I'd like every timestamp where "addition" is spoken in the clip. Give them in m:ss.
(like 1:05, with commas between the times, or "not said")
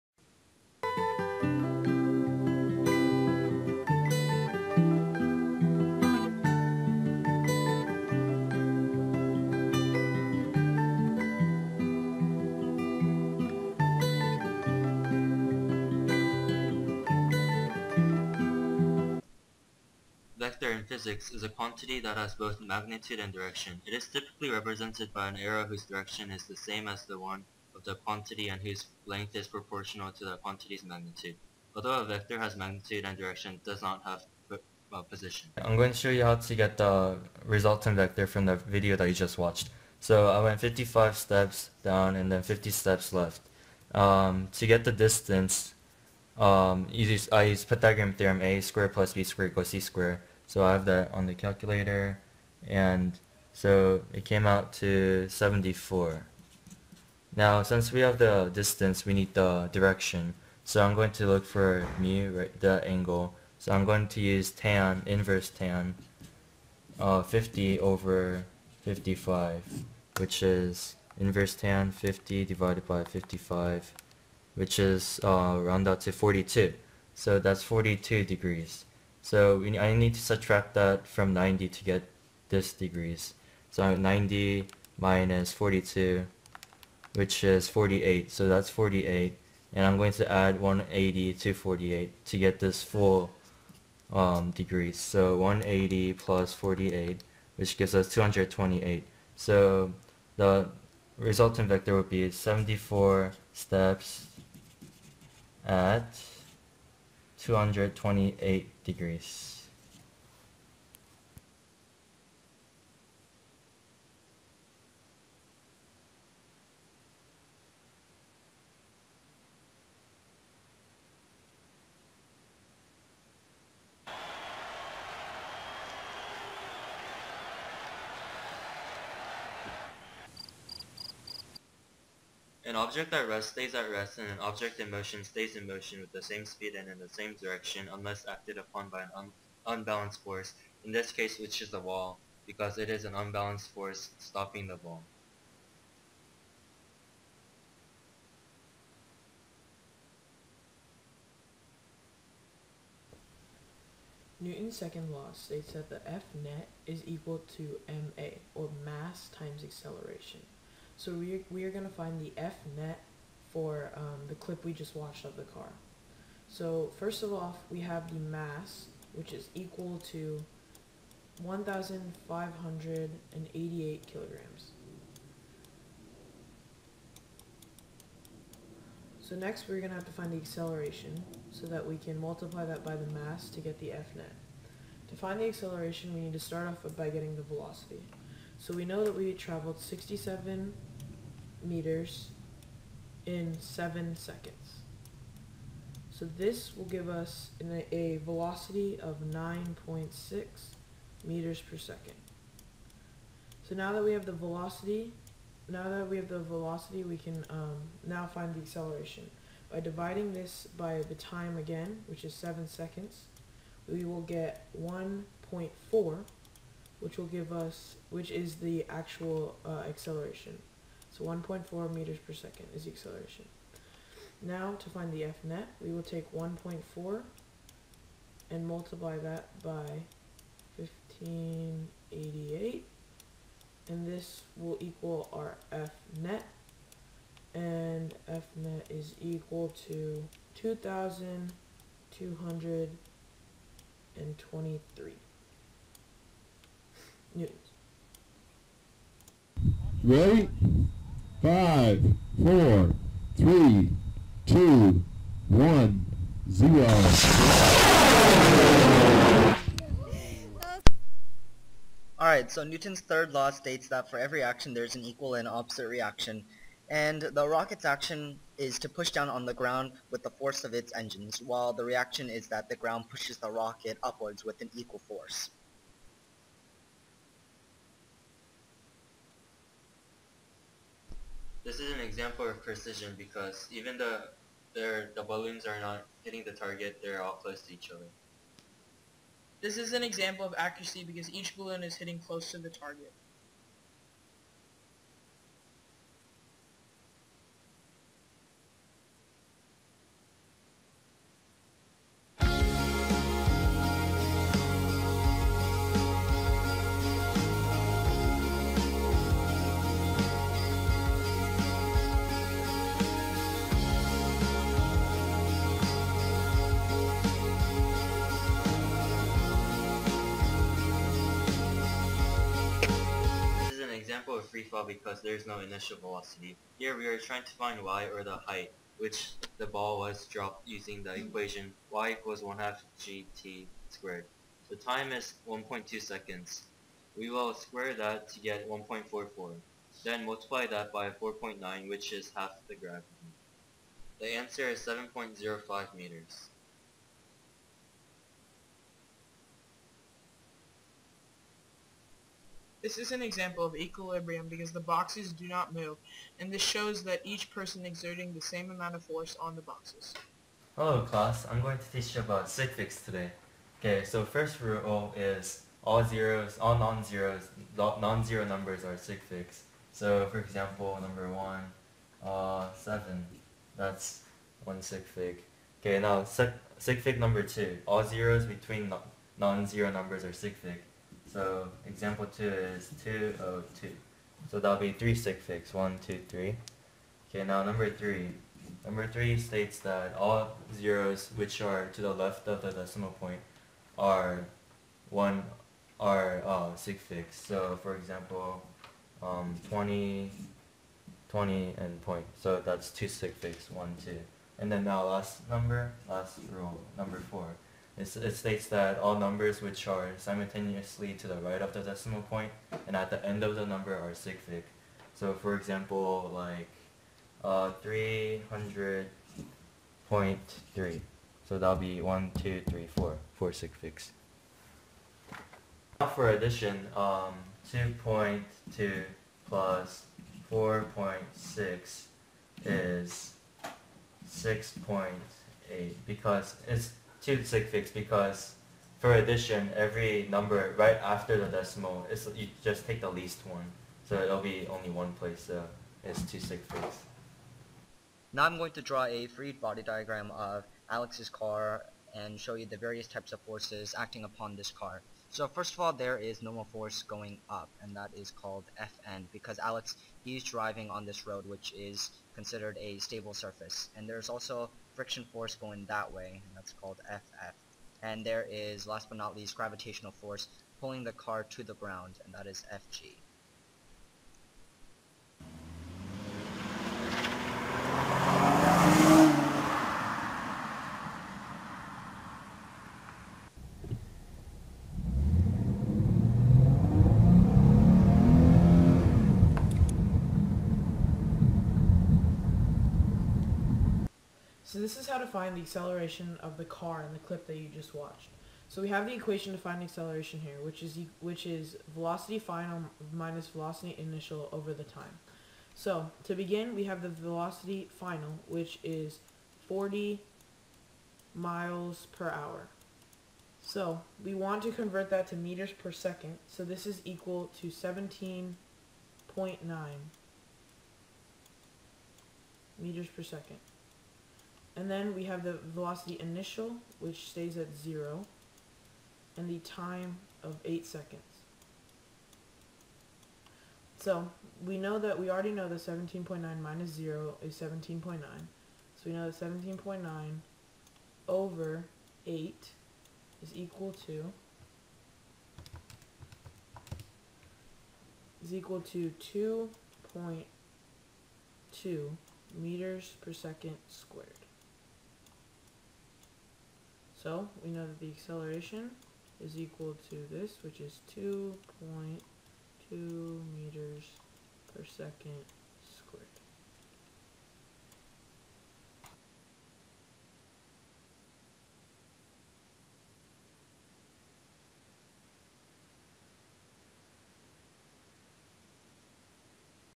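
7:06, 7:19.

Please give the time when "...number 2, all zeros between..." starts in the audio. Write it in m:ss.
6:17.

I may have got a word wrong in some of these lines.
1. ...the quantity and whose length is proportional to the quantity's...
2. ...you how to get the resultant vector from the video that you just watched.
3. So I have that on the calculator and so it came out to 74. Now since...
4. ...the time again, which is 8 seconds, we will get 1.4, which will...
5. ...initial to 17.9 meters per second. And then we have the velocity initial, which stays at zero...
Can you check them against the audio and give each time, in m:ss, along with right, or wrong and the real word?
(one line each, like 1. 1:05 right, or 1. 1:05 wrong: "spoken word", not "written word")
1. 0:27 right
2. 0:36 right
3. 0:50 right
4. 3:31 wrong: "7", not "8"
5. 8:37 wrong: "equal", not "initial".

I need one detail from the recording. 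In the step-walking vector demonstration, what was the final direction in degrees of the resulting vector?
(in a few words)
228 degrees.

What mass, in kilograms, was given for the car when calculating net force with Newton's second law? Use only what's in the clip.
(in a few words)
1,588 kilograms.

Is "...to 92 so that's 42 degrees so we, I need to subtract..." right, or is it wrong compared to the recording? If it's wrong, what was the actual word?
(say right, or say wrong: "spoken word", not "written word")
wrong: "42", not "92".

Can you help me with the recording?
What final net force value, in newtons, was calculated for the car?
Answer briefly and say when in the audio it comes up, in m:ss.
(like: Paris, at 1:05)
2,223 newtons, at 4:00.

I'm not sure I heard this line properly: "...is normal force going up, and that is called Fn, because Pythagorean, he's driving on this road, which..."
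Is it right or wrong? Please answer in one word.
wrong.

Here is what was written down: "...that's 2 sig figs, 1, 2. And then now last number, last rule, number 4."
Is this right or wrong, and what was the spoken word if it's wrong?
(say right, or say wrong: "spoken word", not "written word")
right.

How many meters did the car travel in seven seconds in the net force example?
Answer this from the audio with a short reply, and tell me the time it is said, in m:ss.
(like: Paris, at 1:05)
67 meters, at 3:09.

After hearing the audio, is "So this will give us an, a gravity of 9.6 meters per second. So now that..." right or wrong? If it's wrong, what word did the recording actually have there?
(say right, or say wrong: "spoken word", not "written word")
wrong: "velocity", not "gravity".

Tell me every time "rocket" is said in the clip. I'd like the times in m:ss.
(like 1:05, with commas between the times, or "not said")
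4:27, 4:33.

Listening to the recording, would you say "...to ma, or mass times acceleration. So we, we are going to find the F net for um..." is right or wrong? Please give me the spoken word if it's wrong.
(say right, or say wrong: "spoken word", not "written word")
right.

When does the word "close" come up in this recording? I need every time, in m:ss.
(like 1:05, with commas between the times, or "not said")
4:47, 4:52.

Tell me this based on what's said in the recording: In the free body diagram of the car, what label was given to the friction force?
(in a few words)
FF.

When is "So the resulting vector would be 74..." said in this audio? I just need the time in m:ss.
1:39.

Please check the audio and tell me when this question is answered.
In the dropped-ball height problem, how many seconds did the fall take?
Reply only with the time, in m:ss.
5:35.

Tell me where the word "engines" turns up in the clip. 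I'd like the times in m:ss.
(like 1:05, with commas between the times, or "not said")
4:30.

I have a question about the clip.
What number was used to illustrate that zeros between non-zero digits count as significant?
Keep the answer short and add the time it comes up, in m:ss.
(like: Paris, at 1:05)
202, at 6:23.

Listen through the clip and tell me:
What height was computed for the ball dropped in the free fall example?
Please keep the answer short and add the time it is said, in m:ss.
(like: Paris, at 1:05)
7.05 meters, at 5:44.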